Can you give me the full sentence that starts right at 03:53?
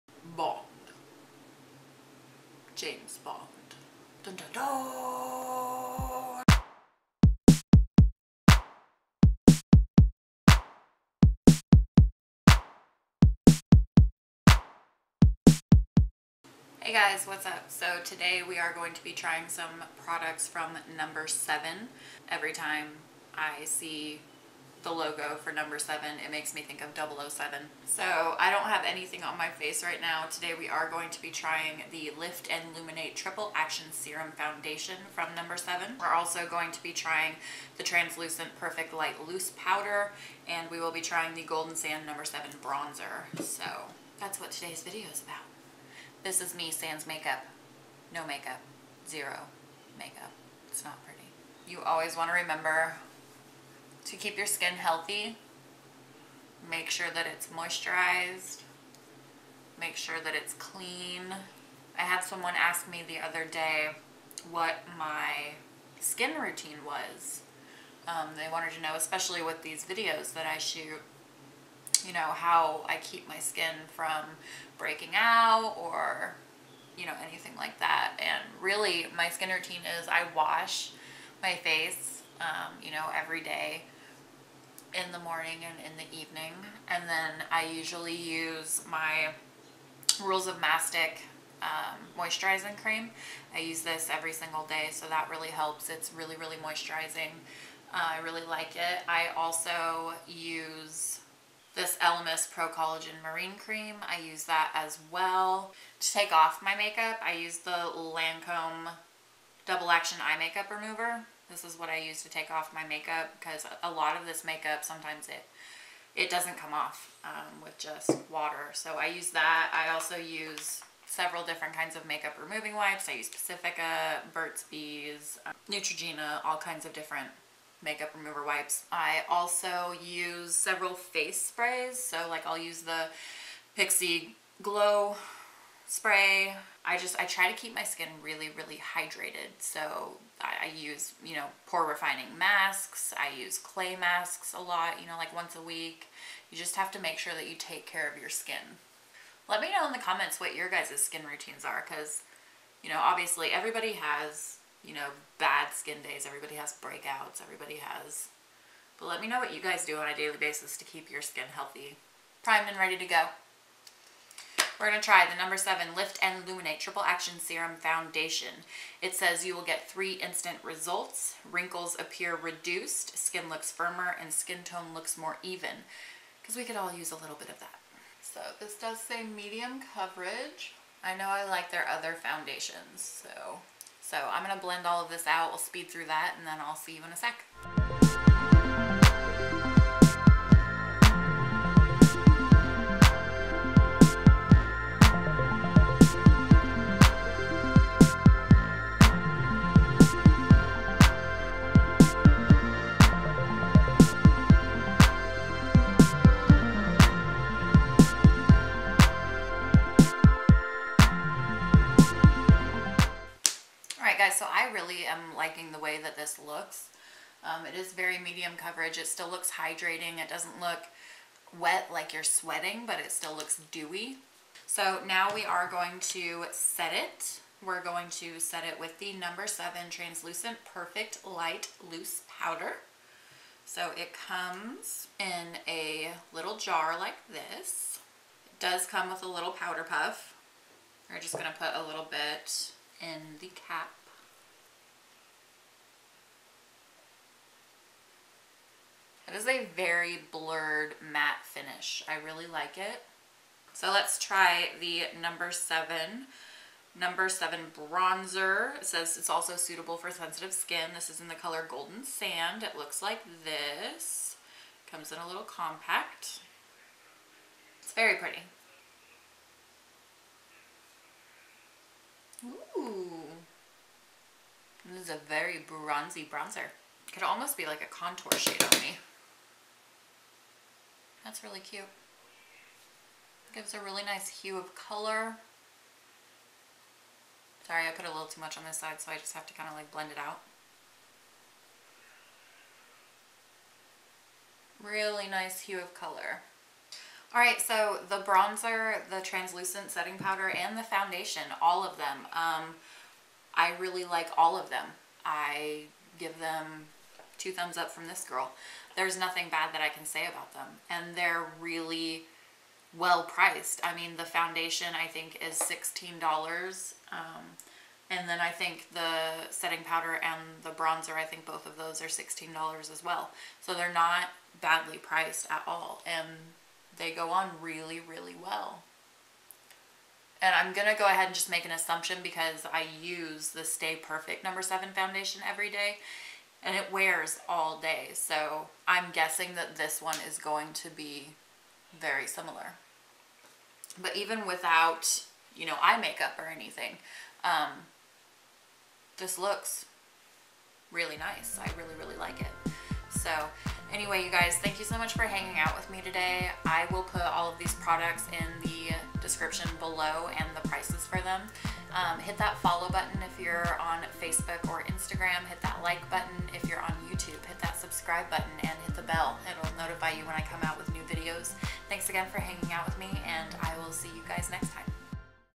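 So it comes in a little jar like this.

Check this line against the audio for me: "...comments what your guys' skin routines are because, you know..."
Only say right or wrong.
right.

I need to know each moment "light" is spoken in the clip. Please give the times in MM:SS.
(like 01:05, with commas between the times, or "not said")
00:38, 03:51.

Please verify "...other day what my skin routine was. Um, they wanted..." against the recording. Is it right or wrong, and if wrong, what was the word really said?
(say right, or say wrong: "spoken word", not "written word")
right.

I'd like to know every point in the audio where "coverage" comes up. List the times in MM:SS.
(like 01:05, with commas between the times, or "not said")
02:59, 03:38.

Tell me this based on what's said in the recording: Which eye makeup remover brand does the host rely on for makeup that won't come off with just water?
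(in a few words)
Lancome.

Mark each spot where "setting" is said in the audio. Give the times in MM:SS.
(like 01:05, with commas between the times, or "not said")
04:59, 05:19.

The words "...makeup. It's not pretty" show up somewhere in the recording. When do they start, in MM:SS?
00:49.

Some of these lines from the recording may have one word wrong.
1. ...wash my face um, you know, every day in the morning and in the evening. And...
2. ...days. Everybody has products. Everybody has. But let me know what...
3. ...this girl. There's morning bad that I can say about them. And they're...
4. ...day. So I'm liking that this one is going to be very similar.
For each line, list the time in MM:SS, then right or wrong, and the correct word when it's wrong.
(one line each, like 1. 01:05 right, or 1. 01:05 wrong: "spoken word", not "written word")
1. 01:20 right
2. 02:36 wrong: "breakouts", not "products"
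3. 05:08 wrong: "nothing", not "morning"
4. 05:37 wrong: "guessing", not "liking".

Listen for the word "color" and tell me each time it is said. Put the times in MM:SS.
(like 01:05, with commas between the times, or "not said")
04:21, 04:44, 04:55.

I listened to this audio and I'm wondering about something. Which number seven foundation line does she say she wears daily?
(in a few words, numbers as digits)
Stay Perfect.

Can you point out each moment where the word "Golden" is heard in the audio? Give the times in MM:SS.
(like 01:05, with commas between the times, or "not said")
00:41, 04:21.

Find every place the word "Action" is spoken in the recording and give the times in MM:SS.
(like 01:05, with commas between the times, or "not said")
00:33, 01:49, 02:47.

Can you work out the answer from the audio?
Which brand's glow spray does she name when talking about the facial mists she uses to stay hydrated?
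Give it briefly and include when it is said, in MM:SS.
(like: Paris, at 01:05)
Pixi, at 02:13.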